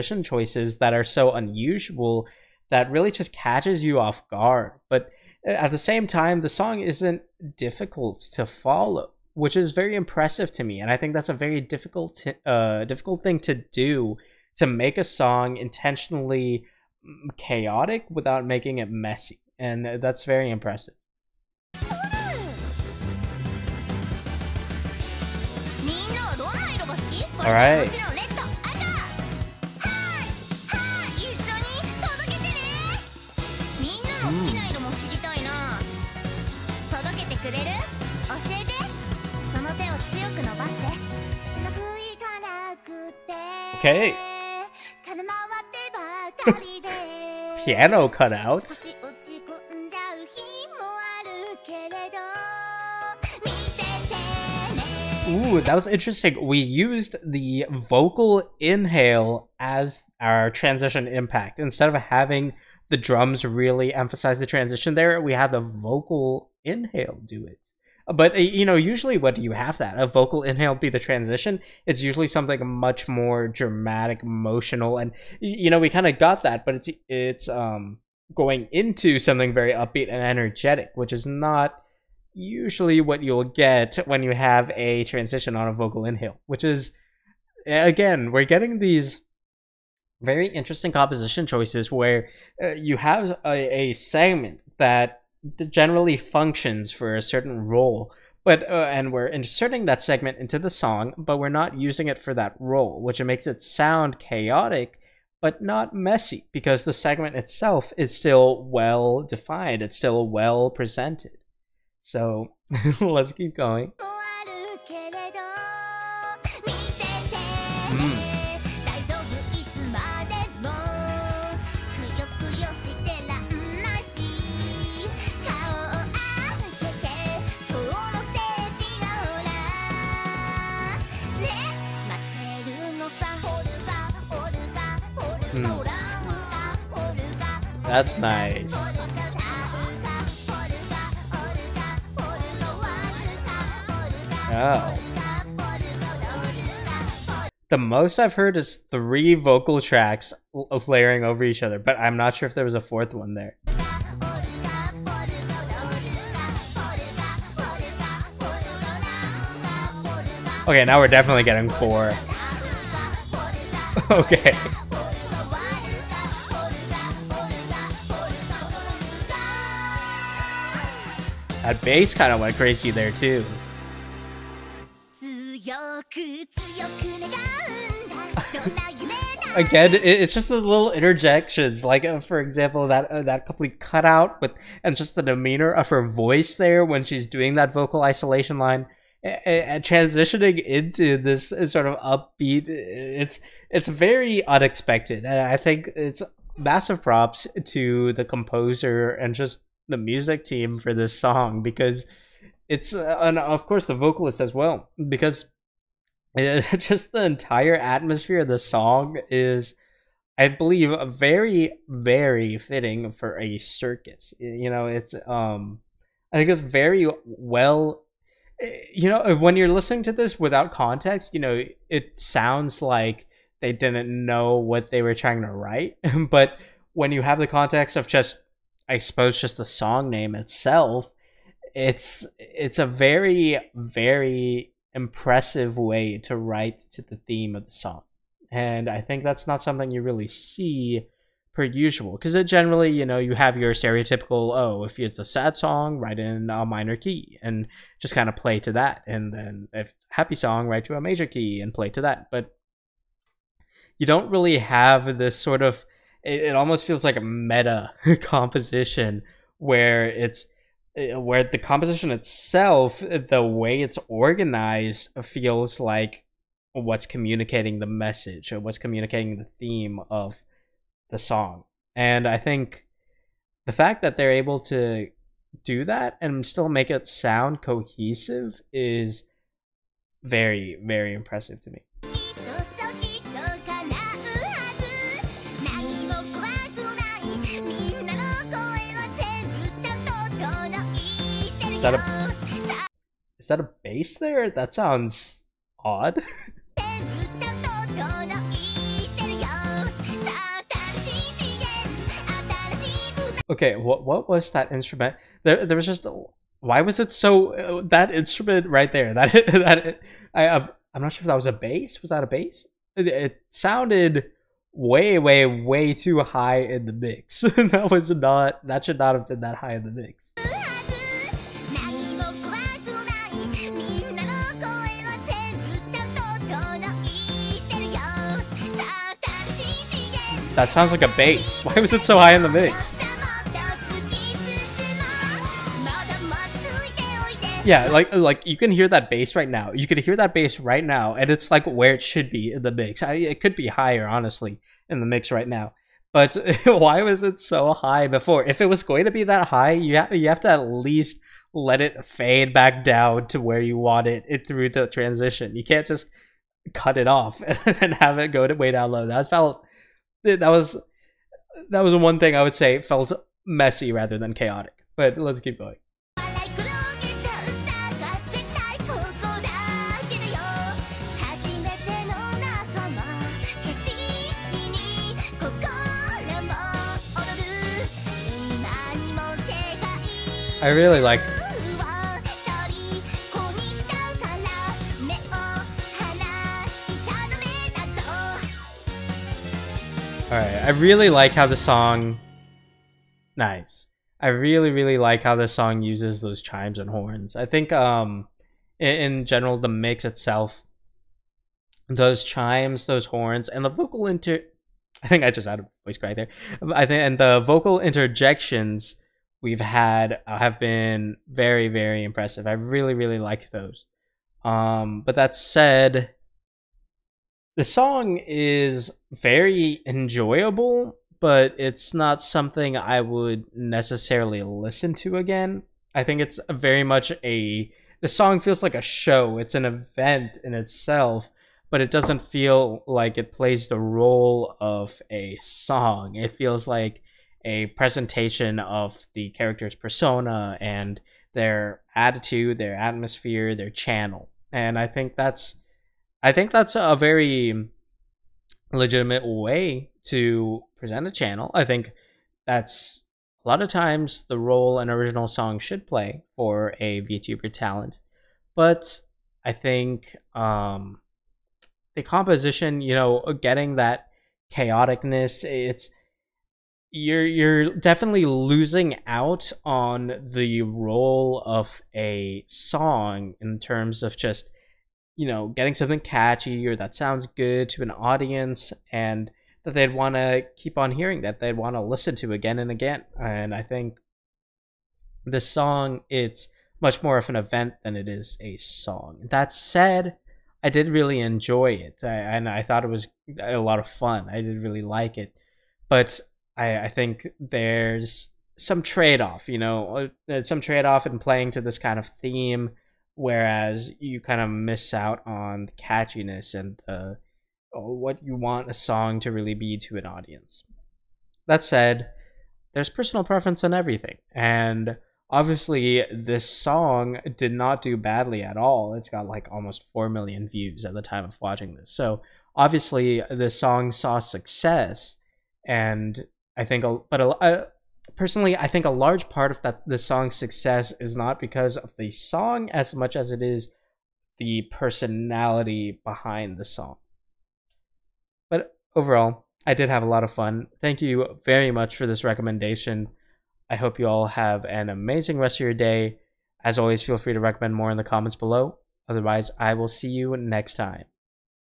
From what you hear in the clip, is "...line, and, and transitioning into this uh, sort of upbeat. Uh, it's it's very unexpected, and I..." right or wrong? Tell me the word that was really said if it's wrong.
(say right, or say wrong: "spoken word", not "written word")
right.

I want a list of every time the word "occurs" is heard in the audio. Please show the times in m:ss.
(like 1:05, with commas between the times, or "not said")
not said.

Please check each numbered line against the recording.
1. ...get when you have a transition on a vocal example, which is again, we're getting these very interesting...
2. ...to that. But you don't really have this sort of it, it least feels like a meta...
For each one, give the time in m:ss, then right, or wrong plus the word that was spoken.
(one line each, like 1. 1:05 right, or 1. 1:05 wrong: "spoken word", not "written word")
1. 1:23 wrong: "inhale", not "example"
2. 4:11 wrong: "almost", not "least".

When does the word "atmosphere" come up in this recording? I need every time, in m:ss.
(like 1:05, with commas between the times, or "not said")
3:27, 7:22.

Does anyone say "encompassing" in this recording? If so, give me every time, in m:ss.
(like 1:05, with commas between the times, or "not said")
not said.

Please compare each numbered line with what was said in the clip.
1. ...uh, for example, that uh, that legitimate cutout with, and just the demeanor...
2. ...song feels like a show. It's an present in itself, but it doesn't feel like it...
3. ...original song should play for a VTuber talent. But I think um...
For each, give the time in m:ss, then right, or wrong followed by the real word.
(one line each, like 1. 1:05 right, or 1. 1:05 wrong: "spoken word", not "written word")
1. 3:02 wrong: "complete", not "legitimate"
2. 7:08 wrong: "event", not "present"
3. 7:34 right.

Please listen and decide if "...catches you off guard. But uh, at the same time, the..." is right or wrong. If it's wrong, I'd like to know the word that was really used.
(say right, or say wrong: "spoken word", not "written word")
right.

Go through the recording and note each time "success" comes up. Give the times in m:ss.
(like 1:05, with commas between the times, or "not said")
8:44, 8:50.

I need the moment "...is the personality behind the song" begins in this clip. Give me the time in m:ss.
8:53.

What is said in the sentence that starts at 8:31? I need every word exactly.
That said, there's personal preference in everything, and obviously this song did not do badly at all.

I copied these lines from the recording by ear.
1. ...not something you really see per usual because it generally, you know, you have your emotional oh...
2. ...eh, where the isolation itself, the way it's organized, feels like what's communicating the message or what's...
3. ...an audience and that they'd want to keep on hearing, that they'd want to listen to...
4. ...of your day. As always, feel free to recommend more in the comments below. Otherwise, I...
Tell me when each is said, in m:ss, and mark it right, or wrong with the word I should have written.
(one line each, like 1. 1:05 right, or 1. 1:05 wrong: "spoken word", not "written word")
1. 3:59 wrong: "stereotypical", not "emotional"
2. 4:20 wrong: "composition", not "isolation"
3. 7:57 right
4. 9:05 right.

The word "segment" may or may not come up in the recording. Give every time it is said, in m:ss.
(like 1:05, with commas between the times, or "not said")
1:33, 1:40, 1:46.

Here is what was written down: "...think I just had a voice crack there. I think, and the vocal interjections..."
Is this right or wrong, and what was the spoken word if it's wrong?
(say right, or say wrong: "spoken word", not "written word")
right.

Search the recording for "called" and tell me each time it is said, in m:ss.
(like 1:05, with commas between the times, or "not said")
not said.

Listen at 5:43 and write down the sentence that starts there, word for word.
I, it could be higher, honestly, in the mix right now.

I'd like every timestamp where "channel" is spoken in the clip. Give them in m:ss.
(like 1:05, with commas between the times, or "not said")
7:23, 7:31.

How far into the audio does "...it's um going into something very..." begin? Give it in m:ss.
1:17.